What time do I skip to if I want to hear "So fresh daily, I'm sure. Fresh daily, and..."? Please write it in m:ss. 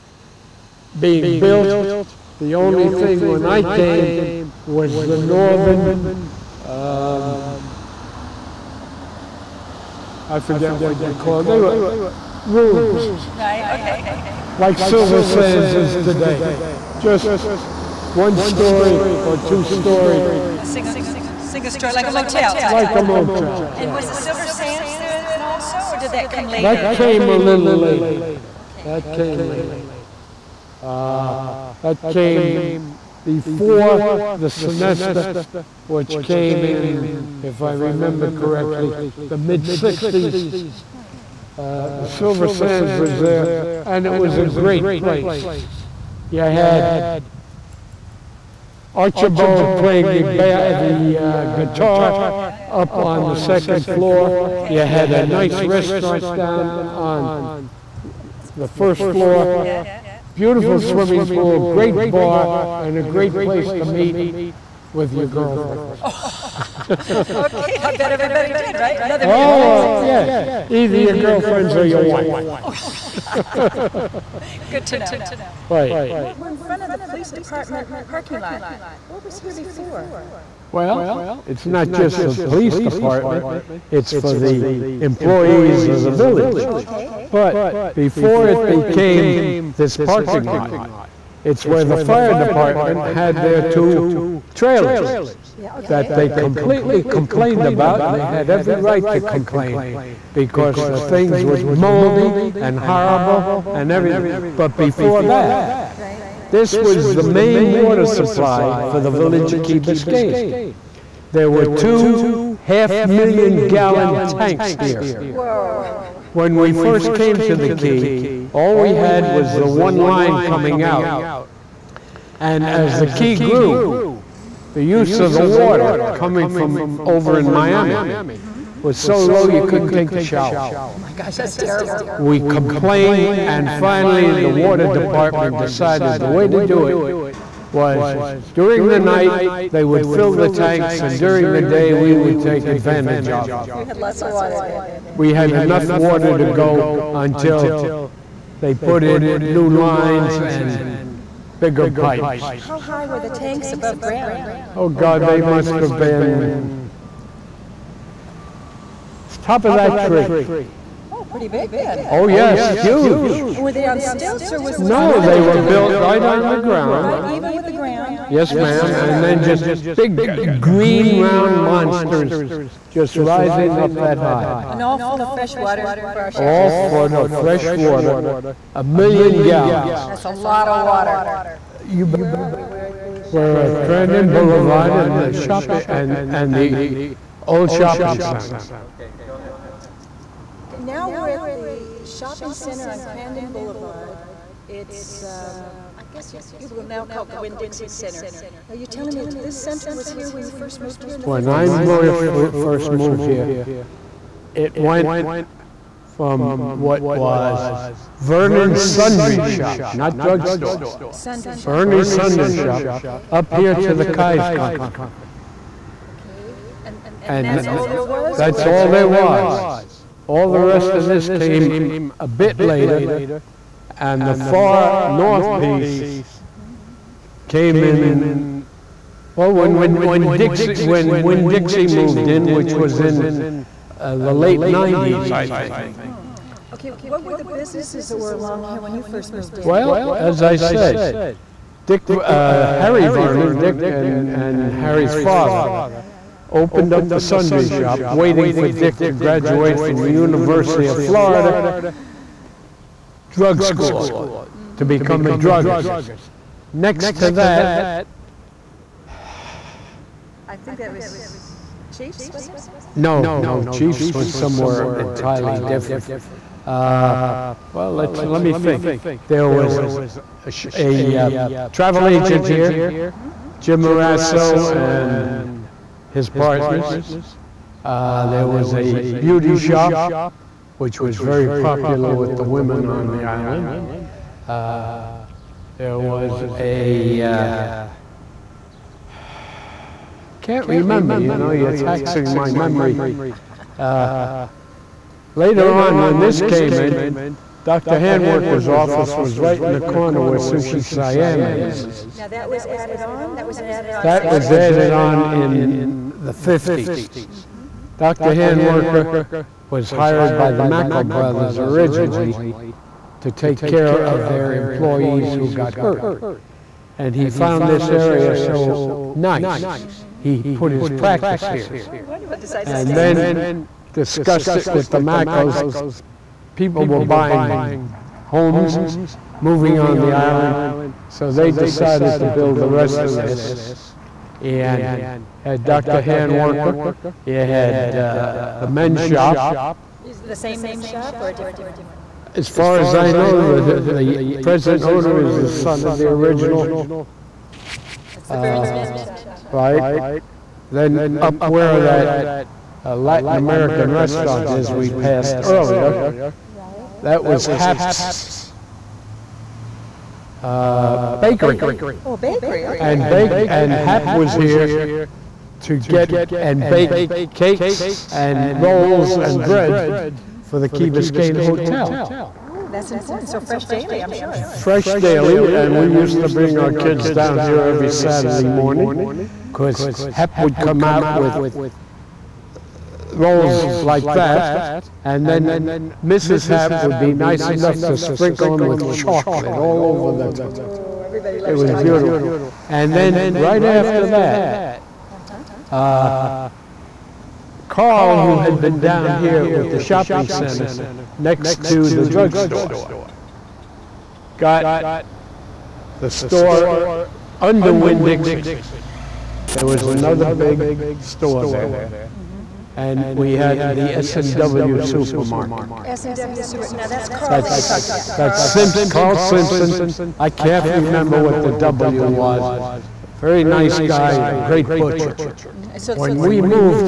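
6:13.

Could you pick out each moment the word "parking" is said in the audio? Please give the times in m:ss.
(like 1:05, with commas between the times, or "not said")
1:18, 1:29.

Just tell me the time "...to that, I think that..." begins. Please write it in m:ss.
4:17.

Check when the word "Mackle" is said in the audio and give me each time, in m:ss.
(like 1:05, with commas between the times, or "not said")
5:10, 5:24.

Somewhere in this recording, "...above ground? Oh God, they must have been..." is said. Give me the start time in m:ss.
2:33.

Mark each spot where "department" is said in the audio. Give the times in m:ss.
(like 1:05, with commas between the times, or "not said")
1:17, 1:22, 1:32, 2:14.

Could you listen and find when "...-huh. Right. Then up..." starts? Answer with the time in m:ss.
5:49.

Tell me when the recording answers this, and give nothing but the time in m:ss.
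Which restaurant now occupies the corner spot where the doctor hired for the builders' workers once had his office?
5:00.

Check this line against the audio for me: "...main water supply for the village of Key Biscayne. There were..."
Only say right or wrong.
right.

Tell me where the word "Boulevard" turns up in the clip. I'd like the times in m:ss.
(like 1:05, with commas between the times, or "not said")
3:04, 3:13.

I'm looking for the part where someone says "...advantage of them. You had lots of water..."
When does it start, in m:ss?
2:22.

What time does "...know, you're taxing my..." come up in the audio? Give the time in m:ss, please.
4:51.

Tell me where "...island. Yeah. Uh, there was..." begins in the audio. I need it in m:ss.
4:43.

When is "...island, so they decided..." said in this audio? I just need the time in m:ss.
5:30.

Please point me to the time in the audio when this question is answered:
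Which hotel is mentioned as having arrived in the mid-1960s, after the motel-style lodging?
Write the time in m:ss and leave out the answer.
0:34.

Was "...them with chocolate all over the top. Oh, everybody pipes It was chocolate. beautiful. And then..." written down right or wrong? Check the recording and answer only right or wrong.
wrong.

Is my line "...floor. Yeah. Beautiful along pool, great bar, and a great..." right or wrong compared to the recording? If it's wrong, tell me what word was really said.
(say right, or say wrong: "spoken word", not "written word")
wrong: "swimming", not "along".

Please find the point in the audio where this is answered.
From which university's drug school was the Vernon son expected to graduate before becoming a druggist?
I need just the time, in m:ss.
4:10.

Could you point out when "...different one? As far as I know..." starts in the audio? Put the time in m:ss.
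5:41.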